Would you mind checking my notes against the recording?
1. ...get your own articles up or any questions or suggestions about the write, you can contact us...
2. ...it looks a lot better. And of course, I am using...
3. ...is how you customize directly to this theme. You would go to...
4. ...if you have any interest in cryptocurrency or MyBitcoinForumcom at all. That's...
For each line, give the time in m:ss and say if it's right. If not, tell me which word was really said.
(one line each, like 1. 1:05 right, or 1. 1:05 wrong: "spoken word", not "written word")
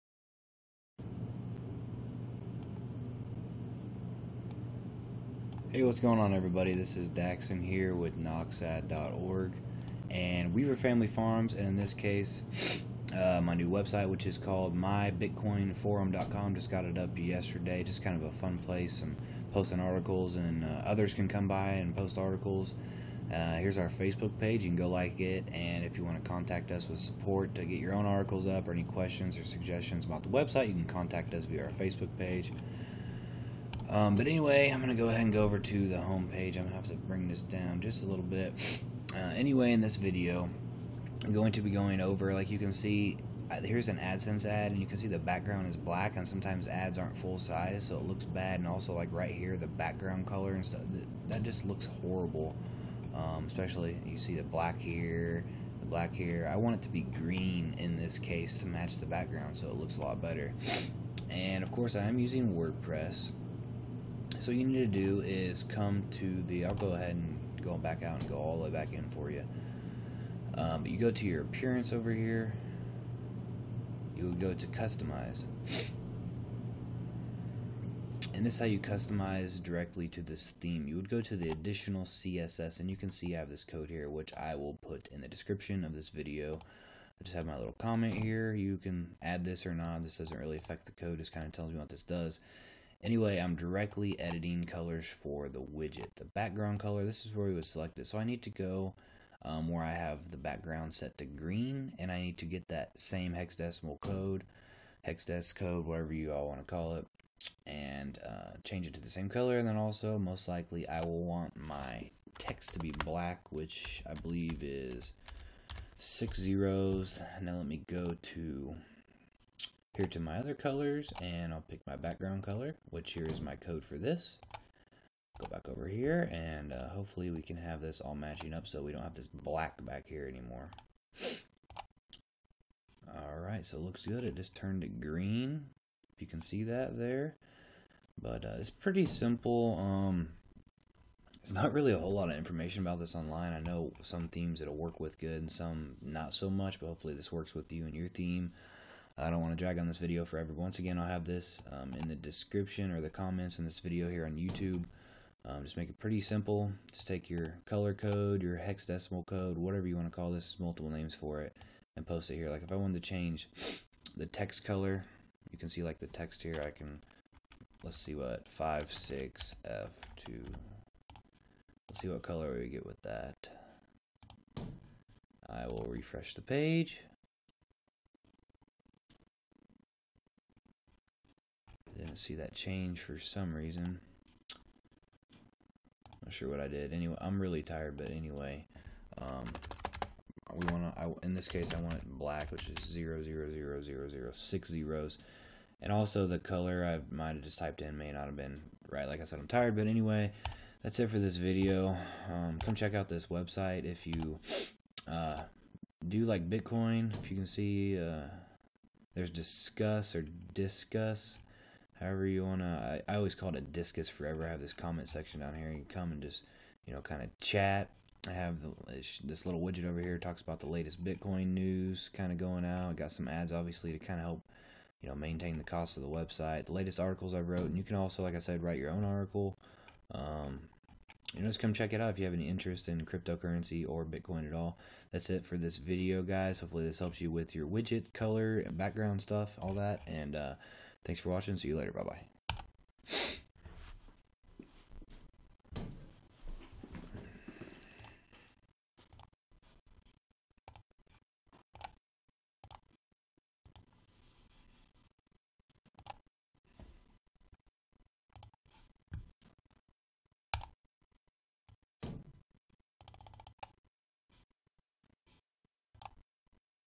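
1. 0:27 wrong: "website", not "write"
2. 0:59 right
3. 1:18 right
4. 3:52 wrong: "Bitcoin", not "MyBitcoinForumcom".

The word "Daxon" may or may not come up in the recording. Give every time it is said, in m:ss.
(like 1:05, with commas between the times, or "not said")
0:07.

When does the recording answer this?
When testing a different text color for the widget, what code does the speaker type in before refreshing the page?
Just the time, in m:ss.
2:48.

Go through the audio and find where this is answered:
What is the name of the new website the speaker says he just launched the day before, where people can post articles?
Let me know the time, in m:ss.
0:14.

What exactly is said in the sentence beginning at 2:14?
It just turned to green, if you can see that there.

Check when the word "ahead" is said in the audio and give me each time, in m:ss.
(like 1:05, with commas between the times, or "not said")
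0:35, 1:06.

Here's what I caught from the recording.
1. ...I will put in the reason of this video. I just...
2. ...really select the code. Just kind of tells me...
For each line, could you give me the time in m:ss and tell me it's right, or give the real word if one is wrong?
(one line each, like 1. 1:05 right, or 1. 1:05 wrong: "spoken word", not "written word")
1. 1:24 wrong: "description", not "reason"
2. 1:30 wrong: "affect", not "select".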